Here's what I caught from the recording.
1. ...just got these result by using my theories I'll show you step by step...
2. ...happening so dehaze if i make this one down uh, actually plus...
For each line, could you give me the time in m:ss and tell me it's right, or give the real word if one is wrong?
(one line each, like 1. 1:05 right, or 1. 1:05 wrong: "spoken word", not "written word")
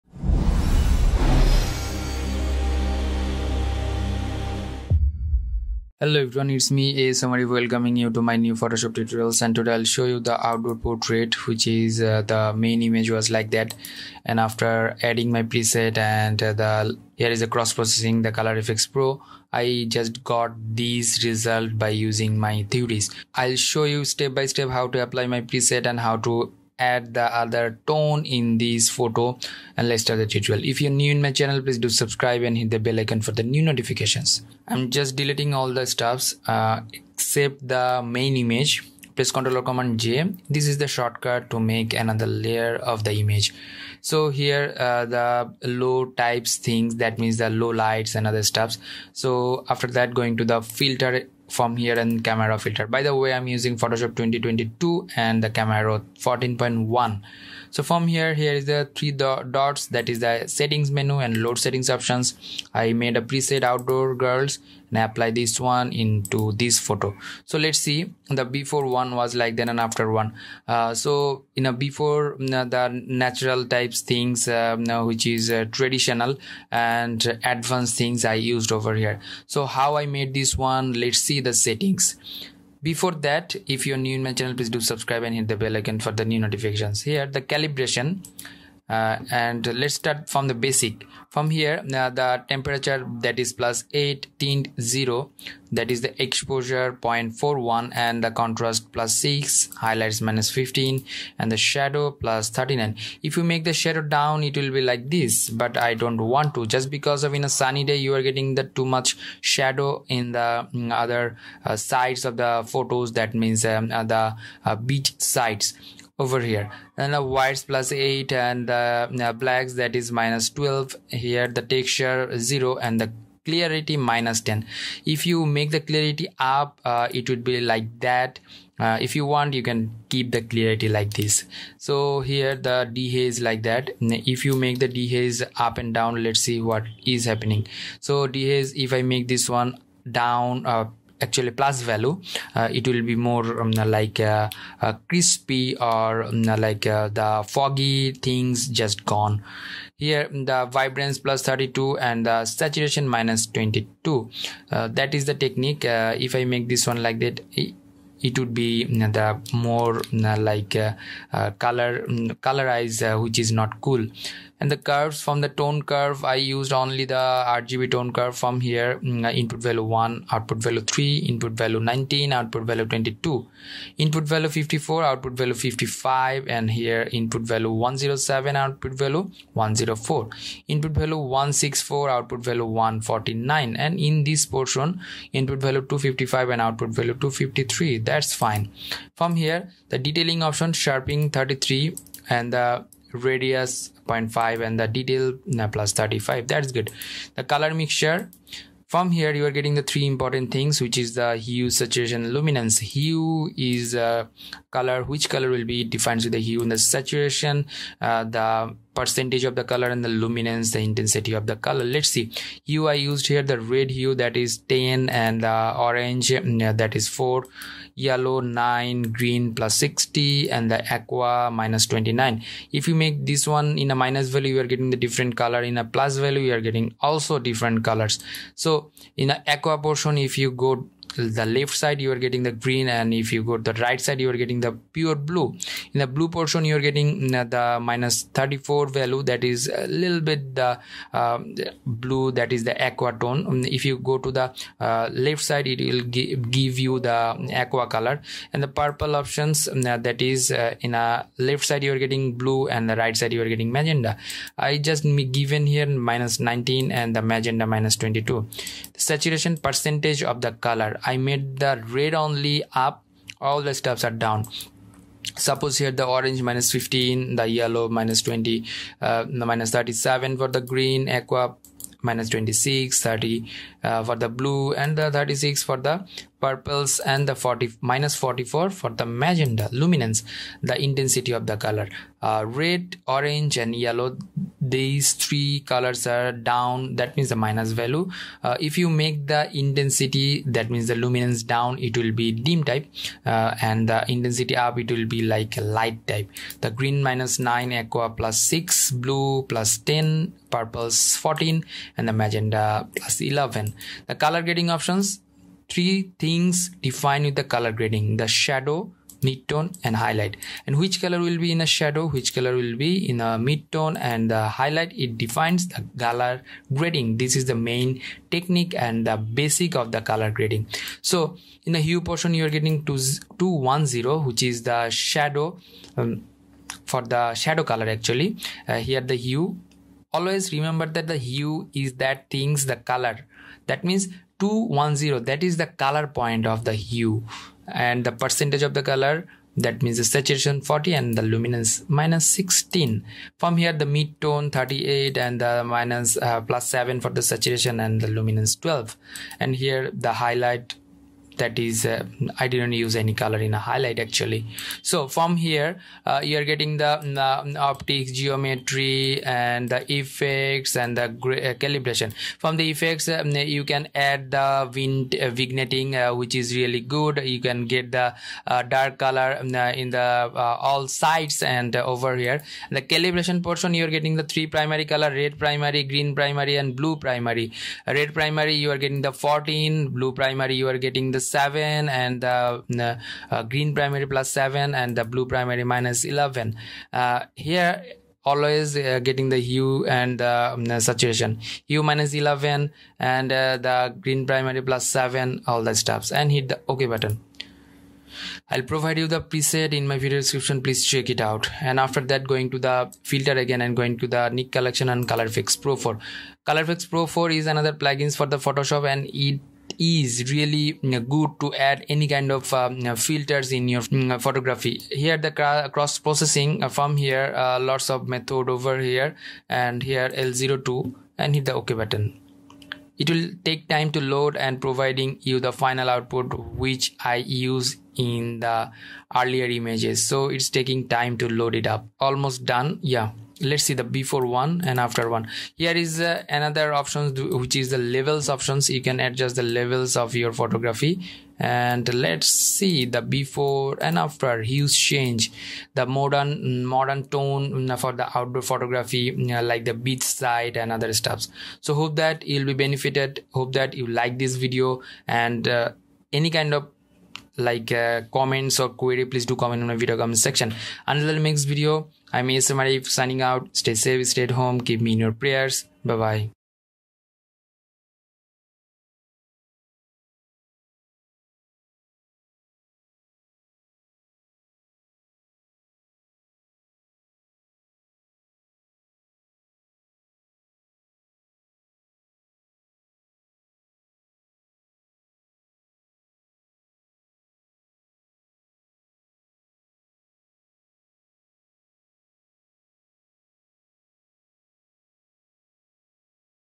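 1. 0:19 right
2. 2:17 right.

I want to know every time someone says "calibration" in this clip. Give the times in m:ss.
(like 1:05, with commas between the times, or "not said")
1:27, 6:01, 6:12.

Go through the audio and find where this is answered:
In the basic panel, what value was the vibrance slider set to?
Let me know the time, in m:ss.
2:30.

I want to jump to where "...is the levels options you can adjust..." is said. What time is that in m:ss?
7:17.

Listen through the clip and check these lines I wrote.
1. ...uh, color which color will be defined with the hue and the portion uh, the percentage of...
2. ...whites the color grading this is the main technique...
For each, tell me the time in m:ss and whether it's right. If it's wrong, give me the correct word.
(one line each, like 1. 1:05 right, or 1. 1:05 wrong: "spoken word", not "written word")
1. 3:23 wrong: "saturation", not "portion"
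2. 5:15 wrong: "defines", not "whites".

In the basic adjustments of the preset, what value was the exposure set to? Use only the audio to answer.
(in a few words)
0.41.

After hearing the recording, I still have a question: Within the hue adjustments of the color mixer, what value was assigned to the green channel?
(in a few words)
+60.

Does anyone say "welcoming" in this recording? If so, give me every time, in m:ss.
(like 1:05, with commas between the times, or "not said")
0:07.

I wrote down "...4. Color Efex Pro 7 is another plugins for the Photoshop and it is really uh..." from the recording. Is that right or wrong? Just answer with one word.
wrong.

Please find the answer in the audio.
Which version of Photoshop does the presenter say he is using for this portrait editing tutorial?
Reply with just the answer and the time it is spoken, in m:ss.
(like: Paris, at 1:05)
Photoshop 2022, at 0:53.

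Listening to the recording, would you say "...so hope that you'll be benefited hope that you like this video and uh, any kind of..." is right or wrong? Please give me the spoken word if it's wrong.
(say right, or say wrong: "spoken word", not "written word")
right.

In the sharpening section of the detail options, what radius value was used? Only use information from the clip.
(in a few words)
0.5.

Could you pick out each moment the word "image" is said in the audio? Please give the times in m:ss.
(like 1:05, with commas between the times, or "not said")
0:12, 0:38, 0:43, 7:09.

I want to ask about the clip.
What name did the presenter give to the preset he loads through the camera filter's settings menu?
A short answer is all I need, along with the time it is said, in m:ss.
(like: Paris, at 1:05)
outdoor girls, at 1:03.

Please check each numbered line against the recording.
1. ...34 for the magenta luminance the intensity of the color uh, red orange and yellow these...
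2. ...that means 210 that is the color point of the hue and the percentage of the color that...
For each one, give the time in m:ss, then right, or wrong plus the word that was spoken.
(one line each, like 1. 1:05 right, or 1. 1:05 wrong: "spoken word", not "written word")
1. 4:38 wrong: "44", not "34"
2. 5:33 right.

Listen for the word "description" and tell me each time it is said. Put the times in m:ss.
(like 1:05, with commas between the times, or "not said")
6:40.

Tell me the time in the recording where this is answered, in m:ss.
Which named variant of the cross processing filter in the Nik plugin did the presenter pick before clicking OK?
7:00.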